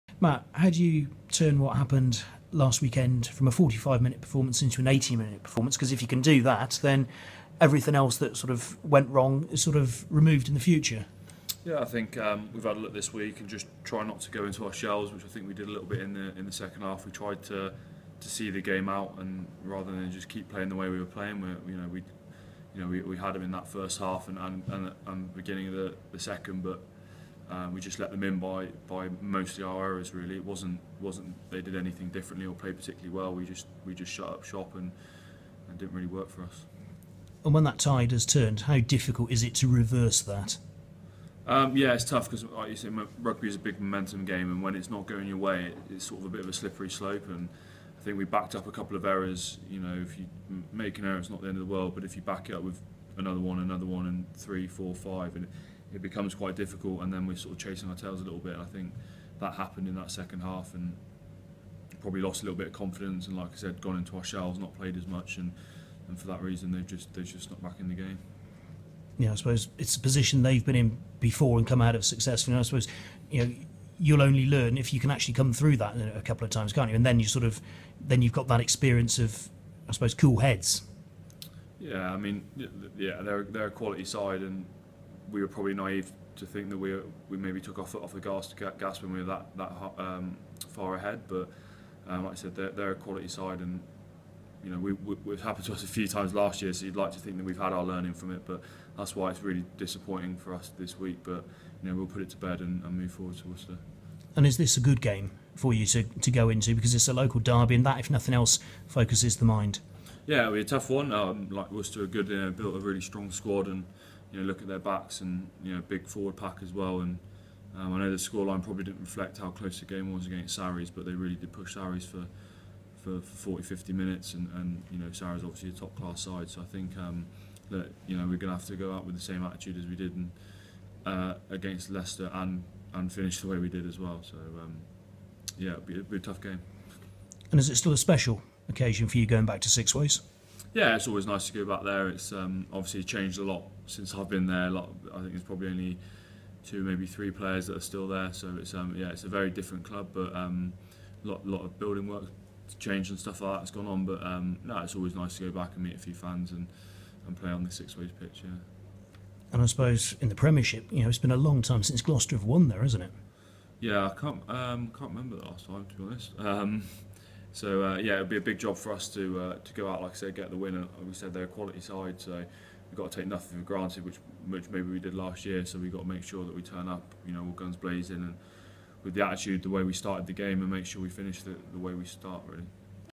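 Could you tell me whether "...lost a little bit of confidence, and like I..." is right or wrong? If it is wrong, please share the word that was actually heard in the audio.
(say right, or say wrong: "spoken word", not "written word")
right.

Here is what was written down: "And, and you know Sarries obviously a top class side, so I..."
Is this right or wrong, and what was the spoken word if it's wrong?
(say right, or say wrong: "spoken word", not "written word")
right.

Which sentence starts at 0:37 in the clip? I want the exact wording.
And when that tide has turned, how difficult is it to reverse that?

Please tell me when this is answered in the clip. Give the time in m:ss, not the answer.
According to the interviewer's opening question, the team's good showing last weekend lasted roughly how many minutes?
0:03.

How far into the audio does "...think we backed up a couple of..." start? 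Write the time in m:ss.
0:48.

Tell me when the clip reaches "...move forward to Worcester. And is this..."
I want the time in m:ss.
1:42.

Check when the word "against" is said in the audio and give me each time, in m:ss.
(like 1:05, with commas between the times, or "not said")
2:00, 2:11.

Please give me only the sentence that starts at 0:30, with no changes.
Really, it wasn't wasn't they did anything differently or played particularly well.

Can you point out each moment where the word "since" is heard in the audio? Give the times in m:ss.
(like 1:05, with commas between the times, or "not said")
2:23, 2:41.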